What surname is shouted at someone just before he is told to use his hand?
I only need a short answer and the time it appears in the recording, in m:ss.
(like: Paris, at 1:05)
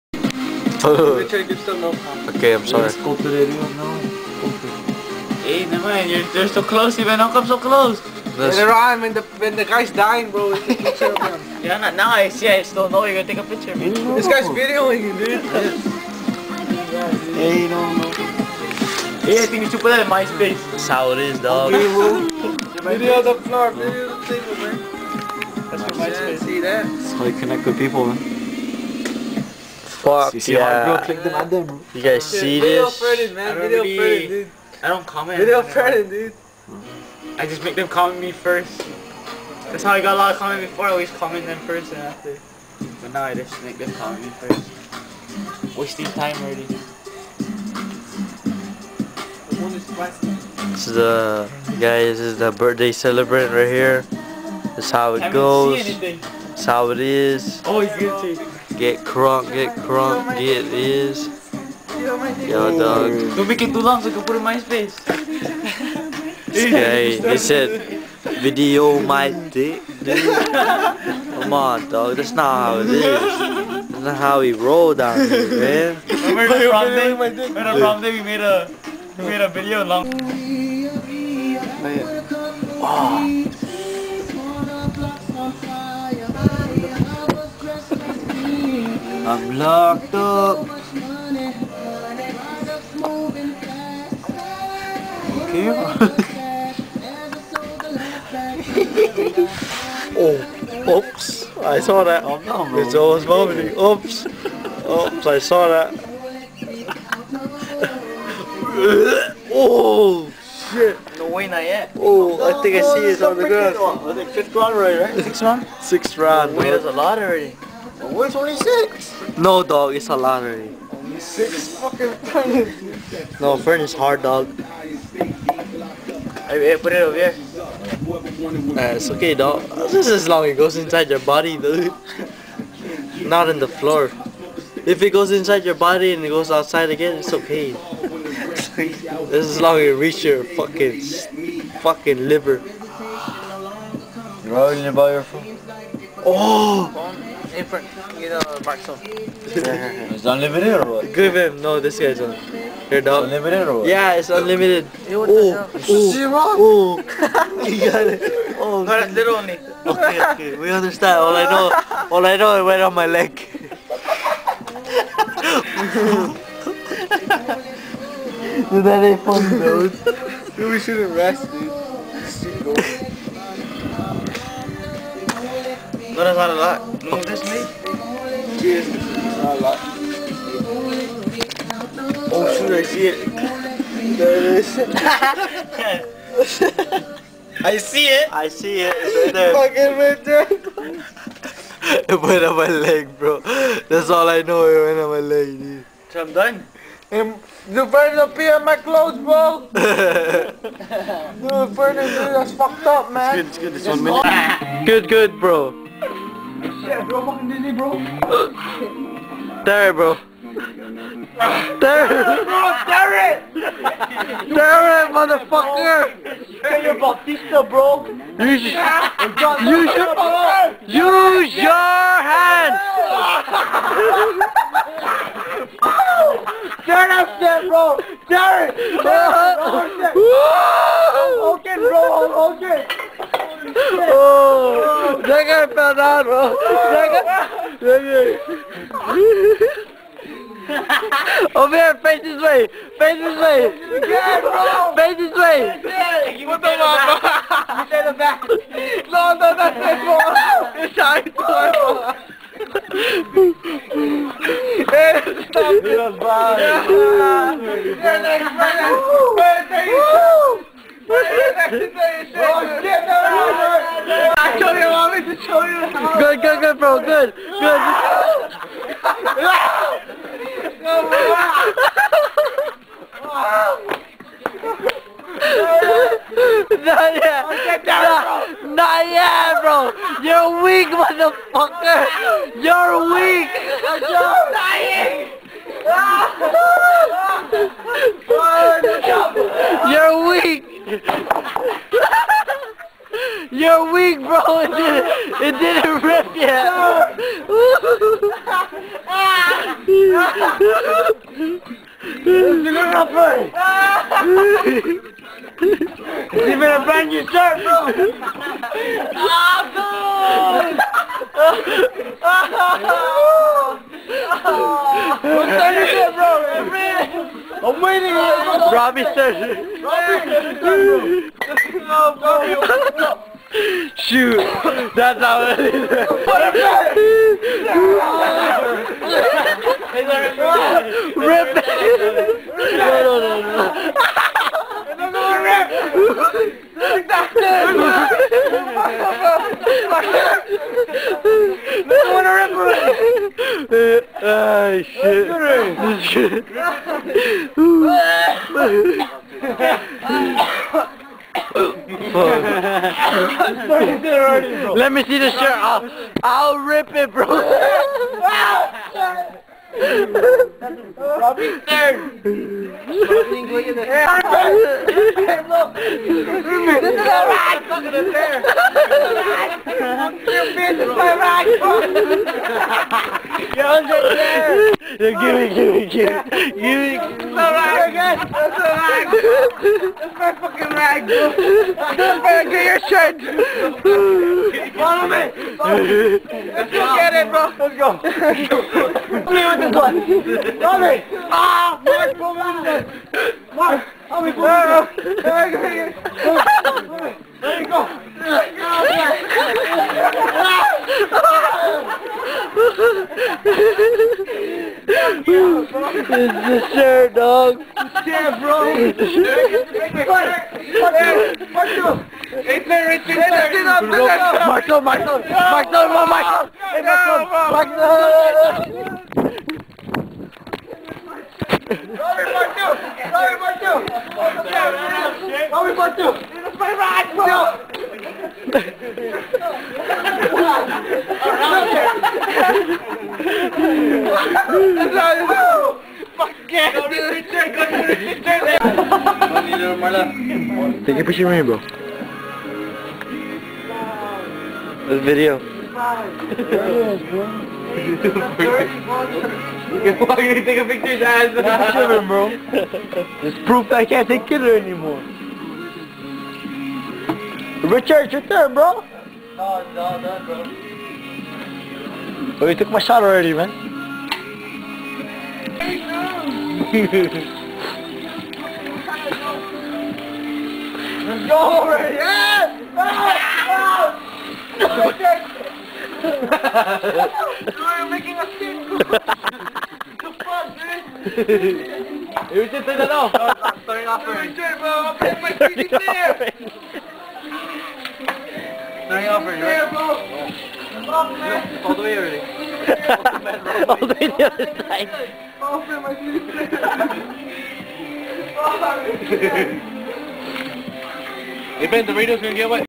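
Bautista, at 3:36.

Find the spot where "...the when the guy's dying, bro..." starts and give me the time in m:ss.
0:09.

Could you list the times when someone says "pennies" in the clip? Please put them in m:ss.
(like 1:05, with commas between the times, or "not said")
2:02.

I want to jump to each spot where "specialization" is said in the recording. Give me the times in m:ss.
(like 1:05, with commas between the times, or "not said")
not said.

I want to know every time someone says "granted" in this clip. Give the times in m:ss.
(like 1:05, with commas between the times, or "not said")
not said.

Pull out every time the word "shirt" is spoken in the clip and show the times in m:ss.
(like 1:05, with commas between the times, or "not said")
5:07, 5:55, 6:22, 6:46.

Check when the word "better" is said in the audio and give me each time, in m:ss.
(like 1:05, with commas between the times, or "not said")
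5:06, 6:22.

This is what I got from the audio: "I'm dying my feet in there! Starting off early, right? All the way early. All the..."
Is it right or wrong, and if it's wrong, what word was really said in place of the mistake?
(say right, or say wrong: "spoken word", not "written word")
wrong: "putting", not "dying".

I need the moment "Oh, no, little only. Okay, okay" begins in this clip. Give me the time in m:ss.
2:38.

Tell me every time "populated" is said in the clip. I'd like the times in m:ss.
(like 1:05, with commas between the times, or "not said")
not said.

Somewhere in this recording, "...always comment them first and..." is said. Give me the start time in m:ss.
0:40.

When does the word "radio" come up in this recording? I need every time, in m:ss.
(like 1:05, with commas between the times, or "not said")
8:21.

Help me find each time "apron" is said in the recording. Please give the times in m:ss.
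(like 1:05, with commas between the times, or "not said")
2:27.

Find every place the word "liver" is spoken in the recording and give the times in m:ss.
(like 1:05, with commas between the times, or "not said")
2:22.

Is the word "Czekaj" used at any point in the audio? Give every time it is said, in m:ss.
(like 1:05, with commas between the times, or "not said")
3:55.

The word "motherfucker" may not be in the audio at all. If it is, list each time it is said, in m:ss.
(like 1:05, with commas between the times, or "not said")
3:35, 4:40.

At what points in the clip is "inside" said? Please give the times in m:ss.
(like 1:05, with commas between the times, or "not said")
2:10, 2:15.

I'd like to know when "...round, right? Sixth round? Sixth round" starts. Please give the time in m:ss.
1:54.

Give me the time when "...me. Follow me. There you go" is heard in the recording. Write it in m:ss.
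6:34.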